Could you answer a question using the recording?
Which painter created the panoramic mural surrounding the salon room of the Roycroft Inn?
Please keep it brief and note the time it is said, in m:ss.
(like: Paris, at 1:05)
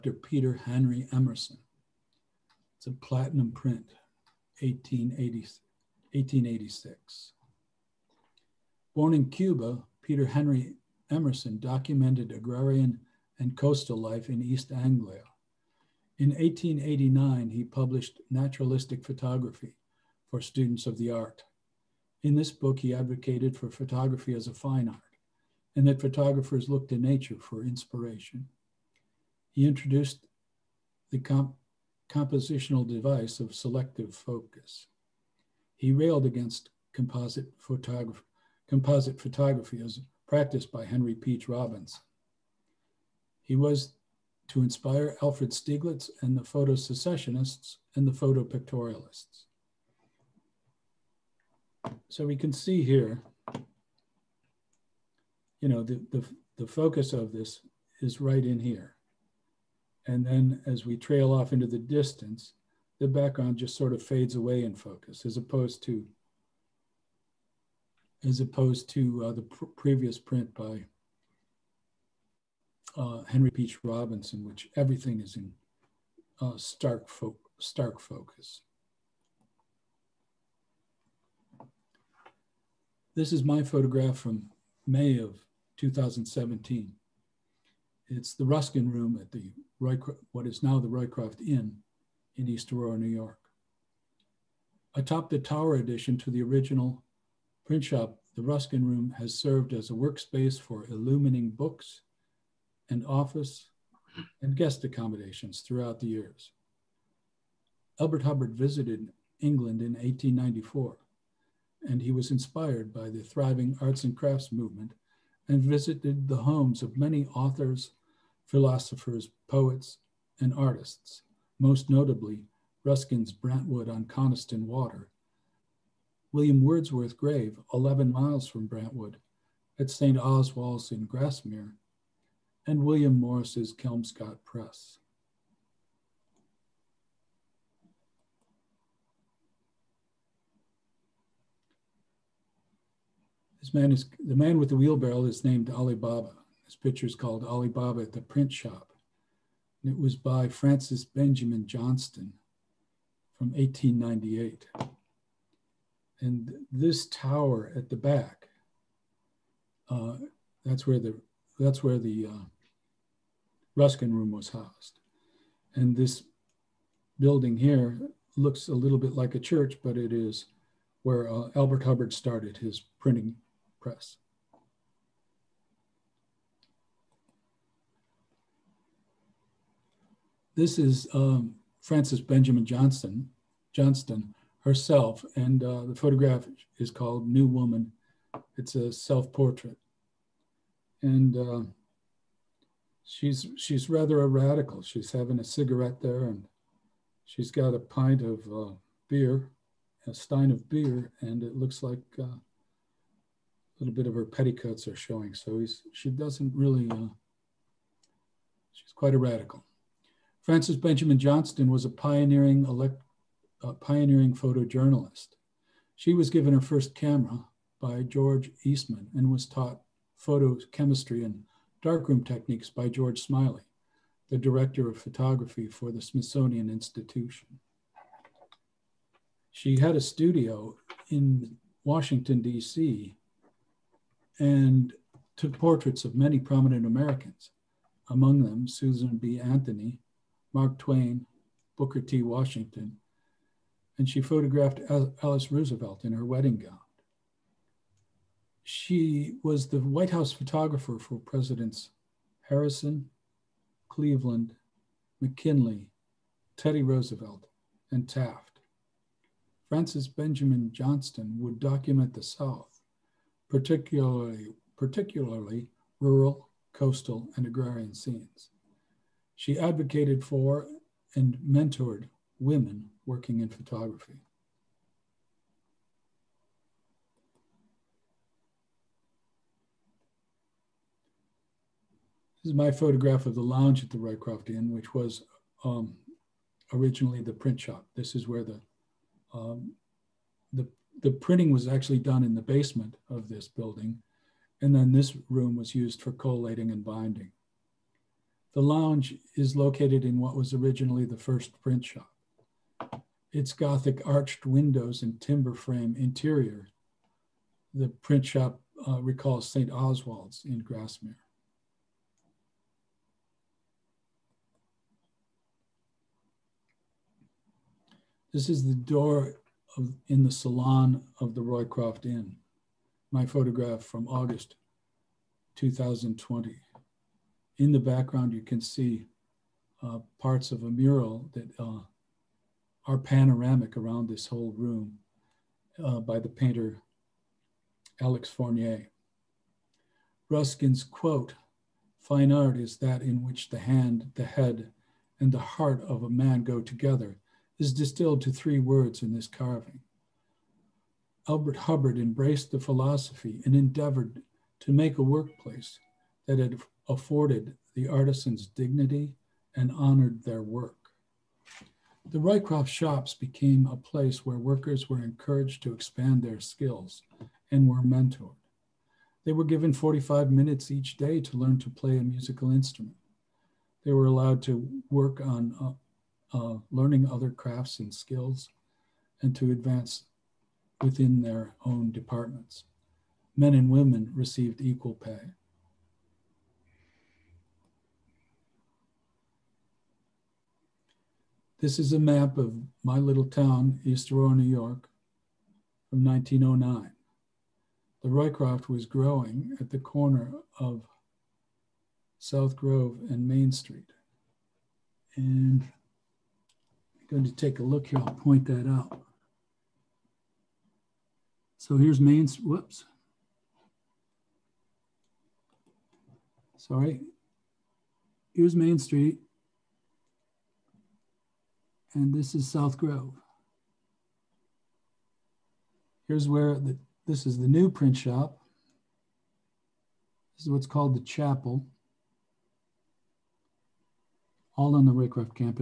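Alex Fournier, at 5:38.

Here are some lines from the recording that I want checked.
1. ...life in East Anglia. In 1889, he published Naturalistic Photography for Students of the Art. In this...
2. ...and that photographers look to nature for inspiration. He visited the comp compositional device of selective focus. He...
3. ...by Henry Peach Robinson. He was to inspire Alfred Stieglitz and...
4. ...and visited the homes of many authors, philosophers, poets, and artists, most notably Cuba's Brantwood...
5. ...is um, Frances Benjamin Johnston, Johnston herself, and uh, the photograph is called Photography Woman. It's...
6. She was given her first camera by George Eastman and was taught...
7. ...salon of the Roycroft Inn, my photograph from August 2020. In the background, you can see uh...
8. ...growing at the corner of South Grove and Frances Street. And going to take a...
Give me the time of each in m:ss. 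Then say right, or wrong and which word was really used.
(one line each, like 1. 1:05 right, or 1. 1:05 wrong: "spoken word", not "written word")
1. 0:13 right
2. 0:25 wrong: "introduced", not "visited"
3. 0:40 right
4. 1:55 wrong: "Ruskin", not "Cuba"
5. 3:00 wrong: "New", not "Photography"
6. 3:35 right
7. 5:20 right
8. 6:38 wrong: "Main", not "Frances".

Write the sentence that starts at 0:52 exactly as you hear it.
So we can see here, you know, the, the, the focus of this is right in here.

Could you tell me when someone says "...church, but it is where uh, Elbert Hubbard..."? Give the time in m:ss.
2:49.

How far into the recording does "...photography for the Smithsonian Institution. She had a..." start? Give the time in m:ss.
3:45.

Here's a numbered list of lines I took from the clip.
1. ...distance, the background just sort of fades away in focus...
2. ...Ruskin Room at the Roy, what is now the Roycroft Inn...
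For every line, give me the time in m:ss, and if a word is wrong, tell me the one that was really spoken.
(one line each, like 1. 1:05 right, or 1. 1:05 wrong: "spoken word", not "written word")
1. 1:01 right
2. 1:28 right.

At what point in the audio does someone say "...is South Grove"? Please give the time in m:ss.
7:02.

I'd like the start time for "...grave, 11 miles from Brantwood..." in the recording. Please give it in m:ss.
2:07.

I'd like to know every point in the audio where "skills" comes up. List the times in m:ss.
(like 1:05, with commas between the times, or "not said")
6:06, 6:17.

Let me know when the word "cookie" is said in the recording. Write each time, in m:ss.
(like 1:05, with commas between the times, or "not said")
not said.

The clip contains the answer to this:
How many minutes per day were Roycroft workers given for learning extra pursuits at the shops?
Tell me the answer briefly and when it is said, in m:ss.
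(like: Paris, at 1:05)
45, at 6:09.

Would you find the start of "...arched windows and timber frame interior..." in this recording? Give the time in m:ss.
5:04.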